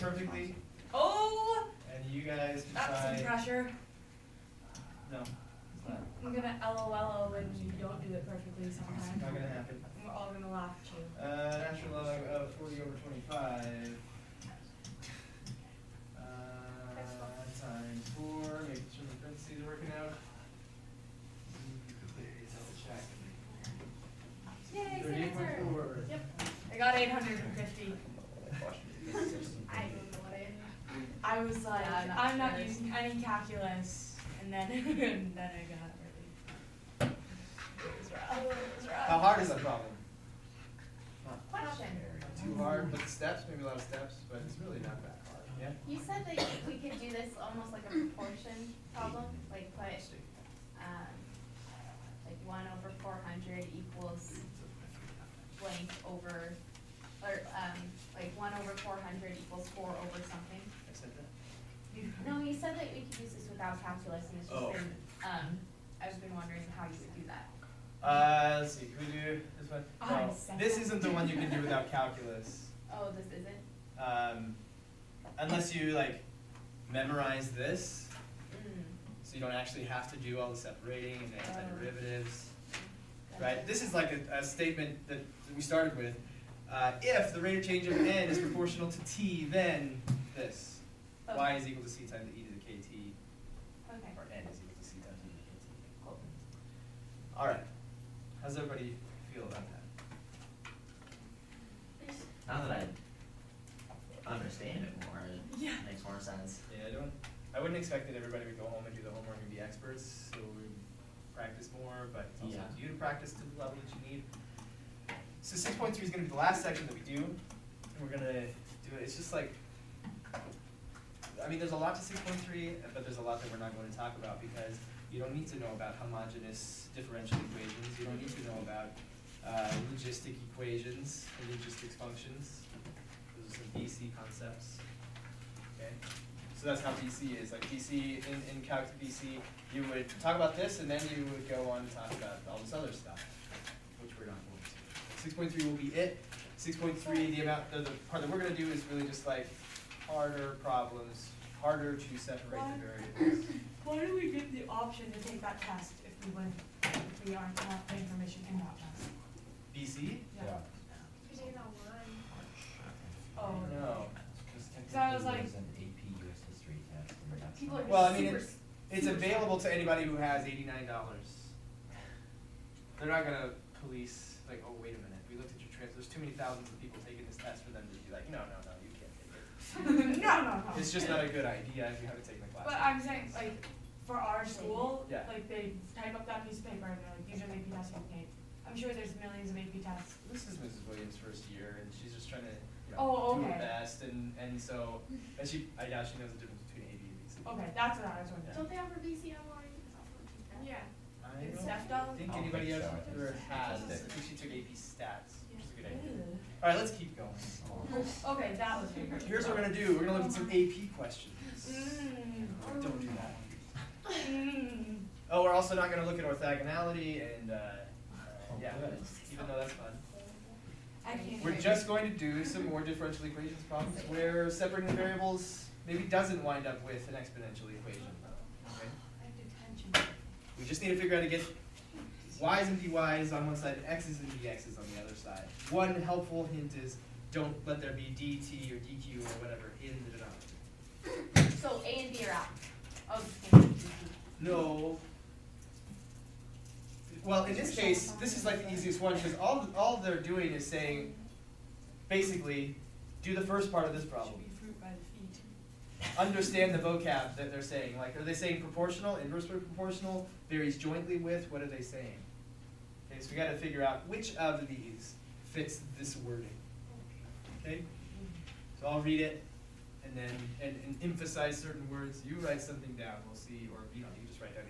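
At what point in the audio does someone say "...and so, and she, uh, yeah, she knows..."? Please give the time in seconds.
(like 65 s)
194 s.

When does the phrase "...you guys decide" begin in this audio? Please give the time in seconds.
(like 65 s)
2 s.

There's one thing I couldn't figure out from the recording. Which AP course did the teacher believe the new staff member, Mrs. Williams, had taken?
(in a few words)
AP Stats.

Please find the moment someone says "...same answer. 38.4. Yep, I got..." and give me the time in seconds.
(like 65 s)
24 s.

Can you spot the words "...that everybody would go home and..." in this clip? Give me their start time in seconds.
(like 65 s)
108 s.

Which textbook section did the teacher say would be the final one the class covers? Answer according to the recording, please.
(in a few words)
6.3.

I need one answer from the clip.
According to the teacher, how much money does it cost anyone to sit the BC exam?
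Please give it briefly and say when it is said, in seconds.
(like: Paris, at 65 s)
$89, at 170 s.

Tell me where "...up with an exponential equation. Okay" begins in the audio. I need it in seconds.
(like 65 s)
226 s.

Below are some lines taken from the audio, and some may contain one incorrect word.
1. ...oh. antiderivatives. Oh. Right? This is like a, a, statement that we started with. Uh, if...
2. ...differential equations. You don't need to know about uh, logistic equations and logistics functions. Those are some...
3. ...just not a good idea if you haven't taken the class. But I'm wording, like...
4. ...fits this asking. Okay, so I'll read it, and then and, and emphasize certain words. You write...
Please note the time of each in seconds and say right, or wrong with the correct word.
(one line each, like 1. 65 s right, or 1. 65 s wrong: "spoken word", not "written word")
1. 81 s right
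2. 126 s right
3. 180 s wrong: "saying", not "wording"
4. 265 s wrong: "wording", not "asking".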